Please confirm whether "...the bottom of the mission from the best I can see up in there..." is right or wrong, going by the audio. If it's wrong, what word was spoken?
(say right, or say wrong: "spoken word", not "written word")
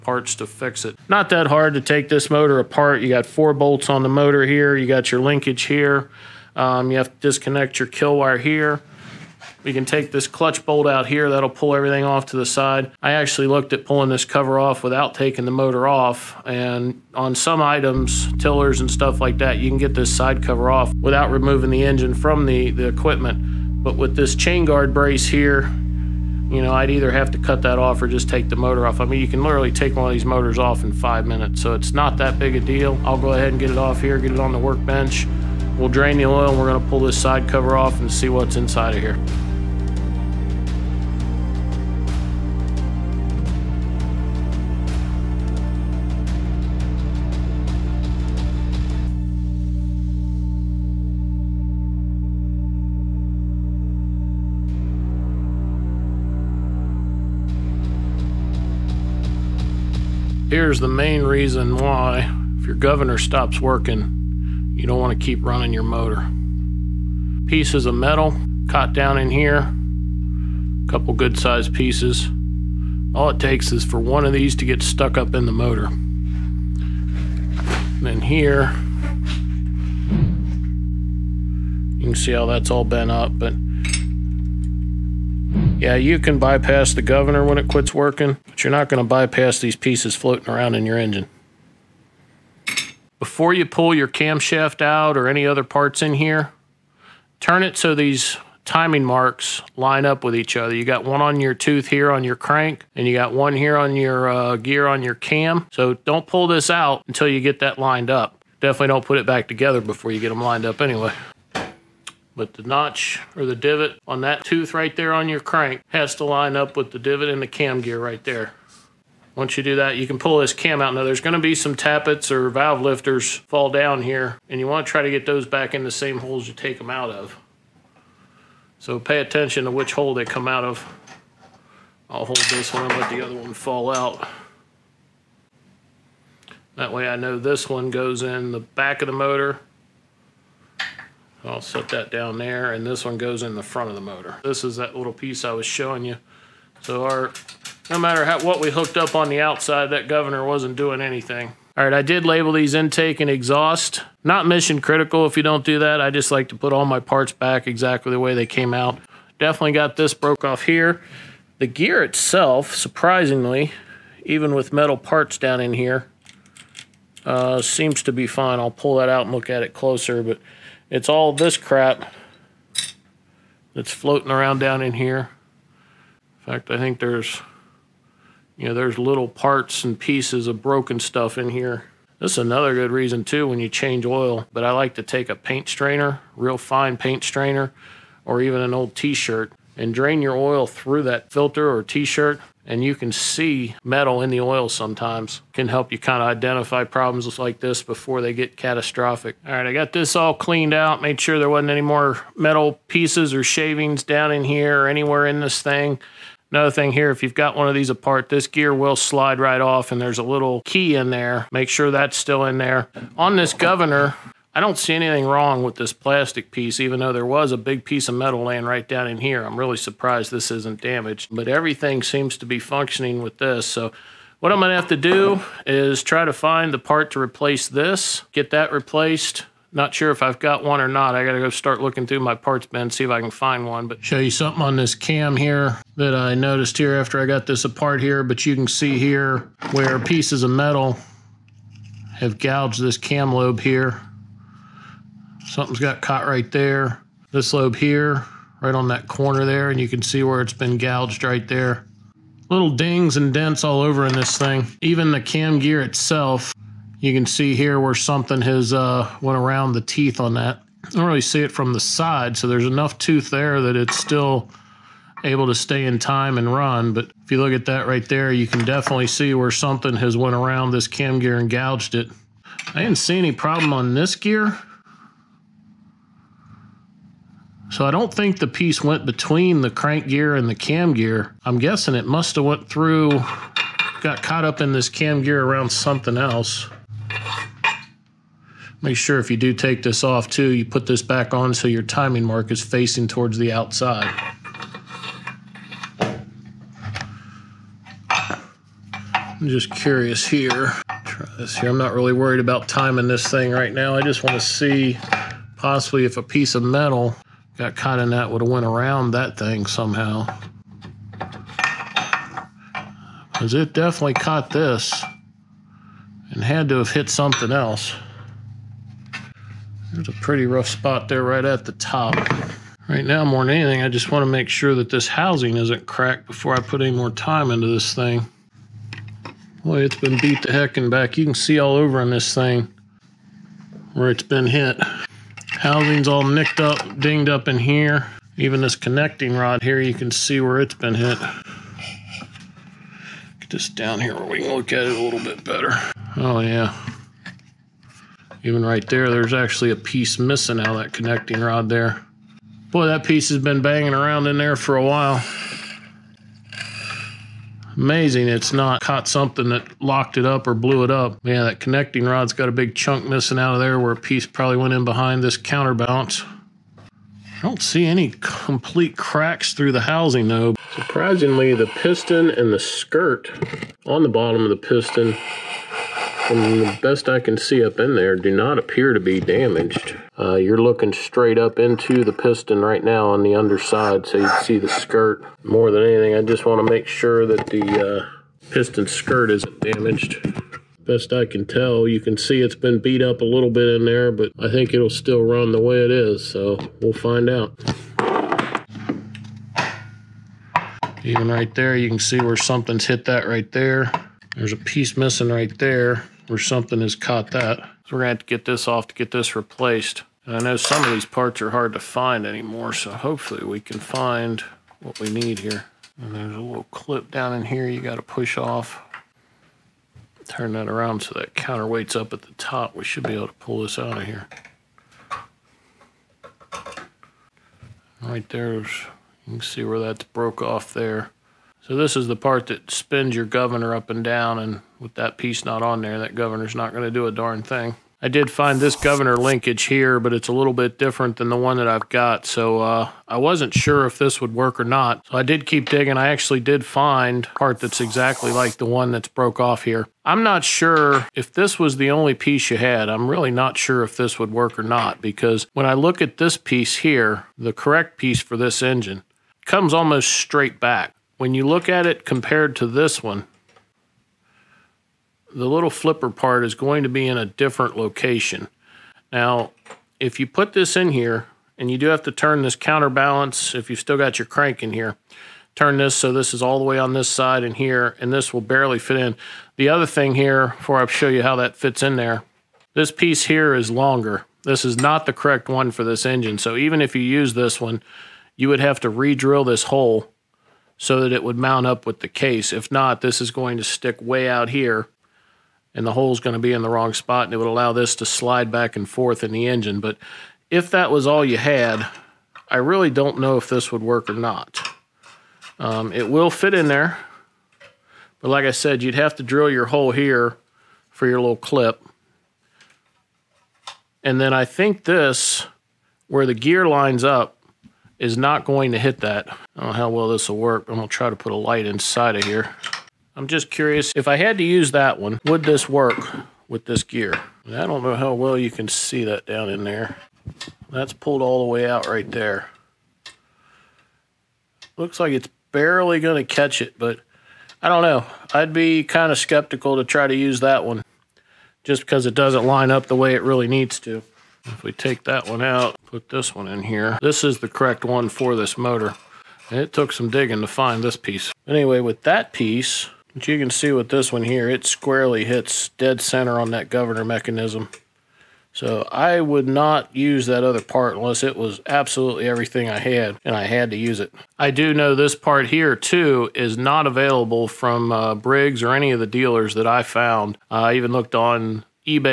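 wrong: "piston", not "mission".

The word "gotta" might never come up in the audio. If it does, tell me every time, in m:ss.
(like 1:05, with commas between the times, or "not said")
3:51, 6:57.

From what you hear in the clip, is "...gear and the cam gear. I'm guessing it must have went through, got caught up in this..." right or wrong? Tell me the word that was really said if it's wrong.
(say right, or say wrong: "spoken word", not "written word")
right.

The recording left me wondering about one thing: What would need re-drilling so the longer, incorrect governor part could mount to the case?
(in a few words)
the hole.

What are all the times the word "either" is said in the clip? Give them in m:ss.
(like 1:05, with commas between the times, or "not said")
0:26.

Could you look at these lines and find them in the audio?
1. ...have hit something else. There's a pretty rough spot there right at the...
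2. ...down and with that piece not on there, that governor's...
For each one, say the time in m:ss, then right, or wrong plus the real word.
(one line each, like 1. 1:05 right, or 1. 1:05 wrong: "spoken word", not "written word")
1. 5:16 right
2. 7:14 right.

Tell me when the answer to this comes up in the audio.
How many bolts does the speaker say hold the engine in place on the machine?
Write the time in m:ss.
0:03.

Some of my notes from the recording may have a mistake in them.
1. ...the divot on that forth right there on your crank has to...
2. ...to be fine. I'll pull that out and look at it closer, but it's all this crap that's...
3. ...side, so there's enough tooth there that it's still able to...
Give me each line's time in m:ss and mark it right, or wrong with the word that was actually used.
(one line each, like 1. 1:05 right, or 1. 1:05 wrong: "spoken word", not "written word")
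1. 1:53 wrong: "tooth", not "forth"
2. 2:48 right
3. 4:21 right.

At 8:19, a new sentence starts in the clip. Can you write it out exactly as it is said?
But if that was all you had, I really don't know if this would work or not.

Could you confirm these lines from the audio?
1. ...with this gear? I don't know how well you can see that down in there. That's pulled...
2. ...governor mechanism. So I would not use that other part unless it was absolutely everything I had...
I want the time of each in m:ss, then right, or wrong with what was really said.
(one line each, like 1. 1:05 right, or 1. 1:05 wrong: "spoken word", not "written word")
1. 8:46 right
2. 9:16 right.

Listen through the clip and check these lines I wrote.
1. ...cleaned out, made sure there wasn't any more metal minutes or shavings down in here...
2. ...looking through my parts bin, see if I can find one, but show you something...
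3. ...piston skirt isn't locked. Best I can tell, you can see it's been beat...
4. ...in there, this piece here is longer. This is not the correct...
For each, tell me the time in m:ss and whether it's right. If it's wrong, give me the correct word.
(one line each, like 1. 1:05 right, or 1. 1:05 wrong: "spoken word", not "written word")
1. 3:20 wrong: "pieces", not "minutes"
2. 3:51 right
3. 6:28 wrong: "damaged", not "locked"
4. 8:01 right.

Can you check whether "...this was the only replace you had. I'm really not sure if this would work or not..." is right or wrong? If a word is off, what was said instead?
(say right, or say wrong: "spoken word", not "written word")
wrong: "piece", not "replace".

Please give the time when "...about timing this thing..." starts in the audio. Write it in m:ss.
5:02.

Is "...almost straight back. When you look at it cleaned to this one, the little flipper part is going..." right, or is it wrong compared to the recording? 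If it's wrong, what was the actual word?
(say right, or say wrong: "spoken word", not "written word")
wrong: "compared", not "cleaned".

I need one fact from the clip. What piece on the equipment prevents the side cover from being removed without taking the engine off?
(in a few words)
chain guard brace.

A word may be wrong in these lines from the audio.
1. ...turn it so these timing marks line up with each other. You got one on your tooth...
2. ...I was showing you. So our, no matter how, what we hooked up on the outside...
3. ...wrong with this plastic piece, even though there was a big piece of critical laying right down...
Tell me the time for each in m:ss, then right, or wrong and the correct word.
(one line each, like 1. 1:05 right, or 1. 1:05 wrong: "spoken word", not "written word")
1. 1:37 right
2. 2:25 right
3. 3:35 wrong: "metal", not "critical".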